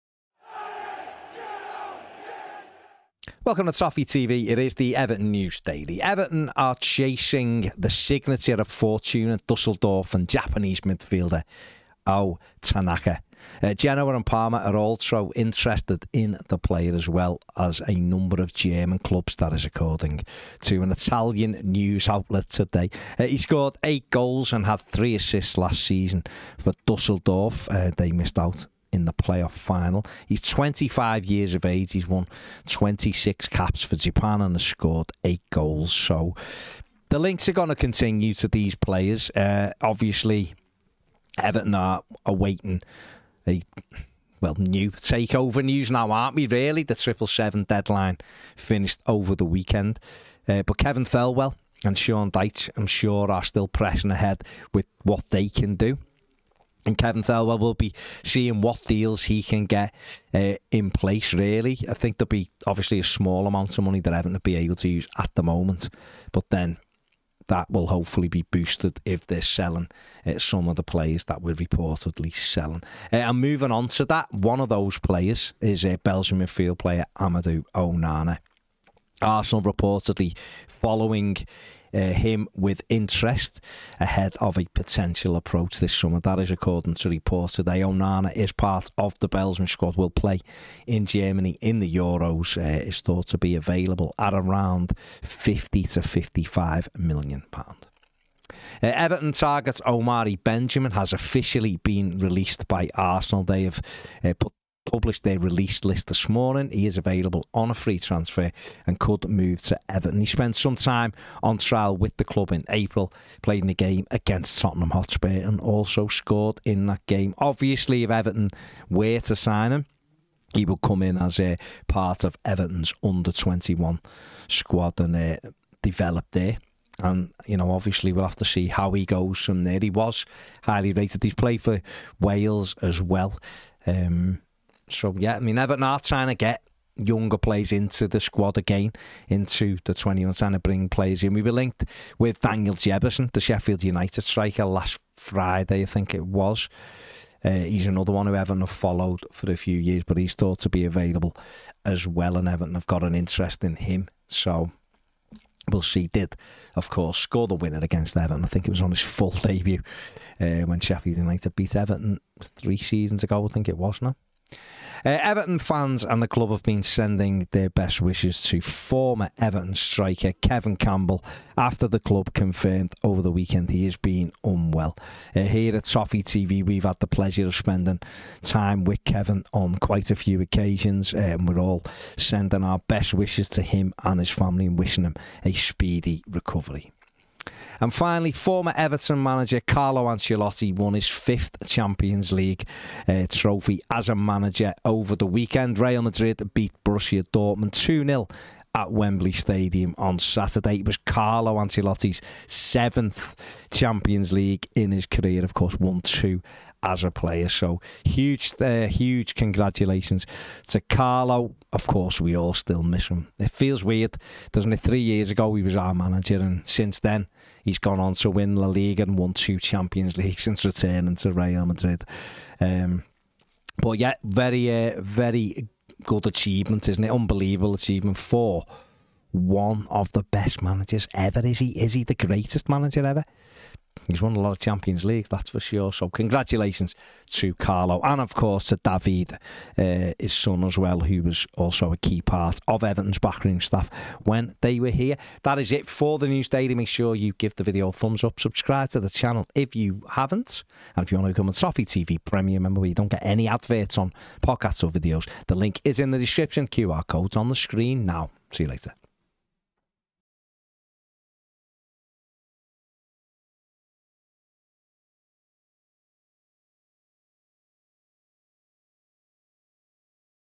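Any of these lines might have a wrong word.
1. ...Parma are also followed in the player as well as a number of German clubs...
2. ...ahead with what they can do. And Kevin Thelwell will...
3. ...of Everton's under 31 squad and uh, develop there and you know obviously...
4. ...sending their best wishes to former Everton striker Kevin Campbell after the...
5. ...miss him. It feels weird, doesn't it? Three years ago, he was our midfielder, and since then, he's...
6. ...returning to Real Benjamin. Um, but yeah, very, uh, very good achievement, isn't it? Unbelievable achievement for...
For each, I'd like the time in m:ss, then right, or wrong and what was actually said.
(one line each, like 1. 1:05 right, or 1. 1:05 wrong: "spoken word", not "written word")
1. 0:14 wrong: "interested", not "followed"
2. 0:54 right
3. 2:02 wrong: "21", not "31"
4. 2:46 right
5. 3:32 wrong: "manager", not "midfielder"
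6. 3:40 wrong: "Madrid", not "Benjamin".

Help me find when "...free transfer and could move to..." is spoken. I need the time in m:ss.
1:47.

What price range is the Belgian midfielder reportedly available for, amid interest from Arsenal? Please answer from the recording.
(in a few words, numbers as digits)
50 to 55 million pounds.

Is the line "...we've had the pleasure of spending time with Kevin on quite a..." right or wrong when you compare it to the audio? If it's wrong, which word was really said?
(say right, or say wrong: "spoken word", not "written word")
right.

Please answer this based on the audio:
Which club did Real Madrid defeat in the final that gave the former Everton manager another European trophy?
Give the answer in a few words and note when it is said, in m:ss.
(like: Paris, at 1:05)
Borussia Dortmund, at 3:16.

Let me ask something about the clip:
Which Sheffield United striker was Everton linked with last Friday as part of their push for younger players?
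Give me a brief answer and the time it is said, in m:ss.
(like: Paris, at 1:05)
Daniel Jebbison, at 2:22.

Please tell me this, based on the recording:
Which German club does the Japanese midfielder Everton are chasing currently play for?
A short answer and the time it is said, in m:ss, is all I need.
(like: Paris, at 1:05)
Fortuna Dusseldorf, at 0:08.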